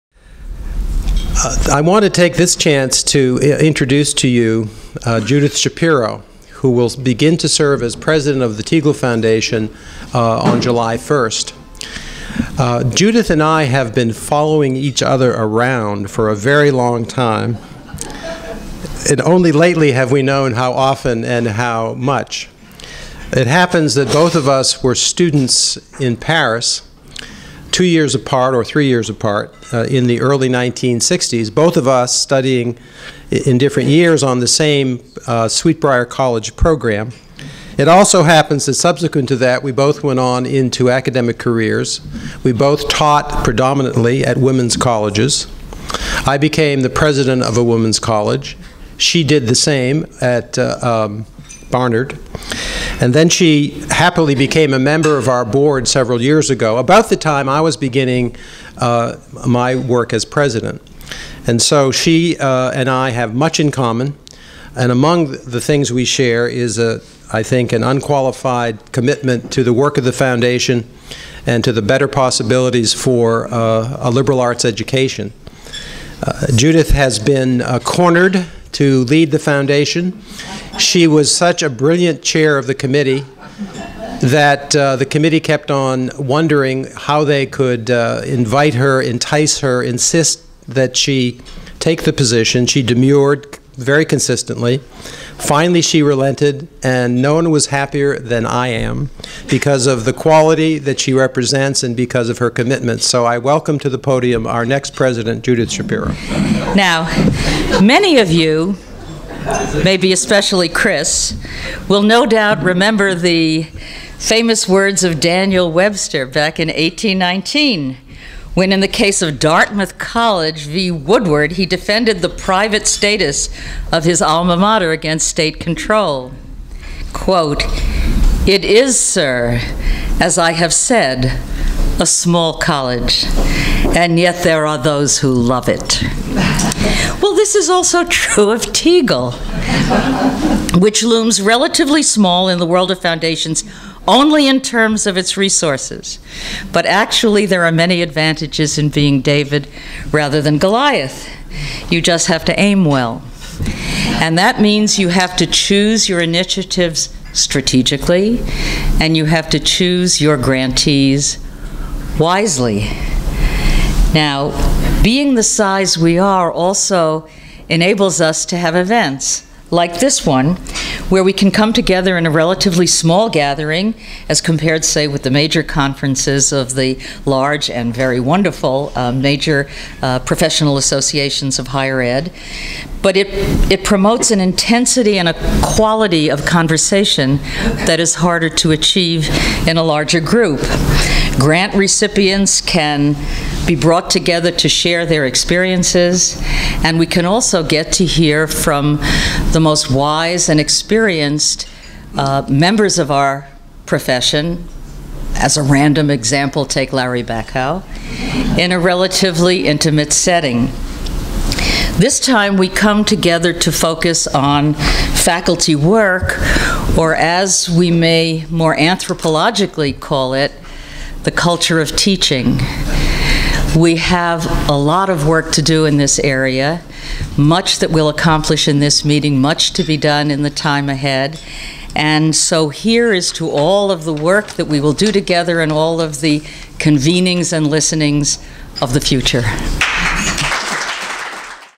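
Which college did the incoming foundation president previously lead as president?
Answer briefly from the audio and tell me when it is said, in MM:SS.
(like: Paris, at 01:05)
Barnard, at 00:51.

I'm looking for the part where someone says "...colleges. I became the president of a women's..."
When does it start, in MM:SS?
00:44.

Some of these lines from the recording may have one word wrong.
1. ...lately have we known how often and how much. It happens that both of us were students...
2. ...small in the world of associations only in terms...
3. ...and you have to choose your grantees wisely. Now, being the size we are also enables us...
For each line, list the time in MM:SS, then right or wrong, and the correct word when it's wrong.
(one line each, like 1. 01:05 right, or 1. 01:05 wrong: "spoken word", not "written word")
1. 00:19 right
2. 02:22 wrong: "foundations", not "associations"
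3. 02:38 right.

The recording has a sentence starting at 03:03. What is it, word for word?
But it, it promotes an intensity and a quality of conversation that is harder to achieve in a larger group.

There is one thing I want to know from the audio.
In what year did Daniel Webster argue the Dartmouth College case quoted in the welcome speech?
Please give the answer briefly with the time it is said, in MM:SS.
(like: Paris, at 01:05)
1819, at 01:56.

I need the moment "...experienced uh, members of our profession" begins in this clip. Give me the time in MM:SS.
03:20.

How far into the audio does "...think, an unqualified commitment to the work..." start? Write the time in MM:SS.
01:07.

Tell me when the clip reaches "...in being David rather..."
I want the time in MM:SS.
02:28.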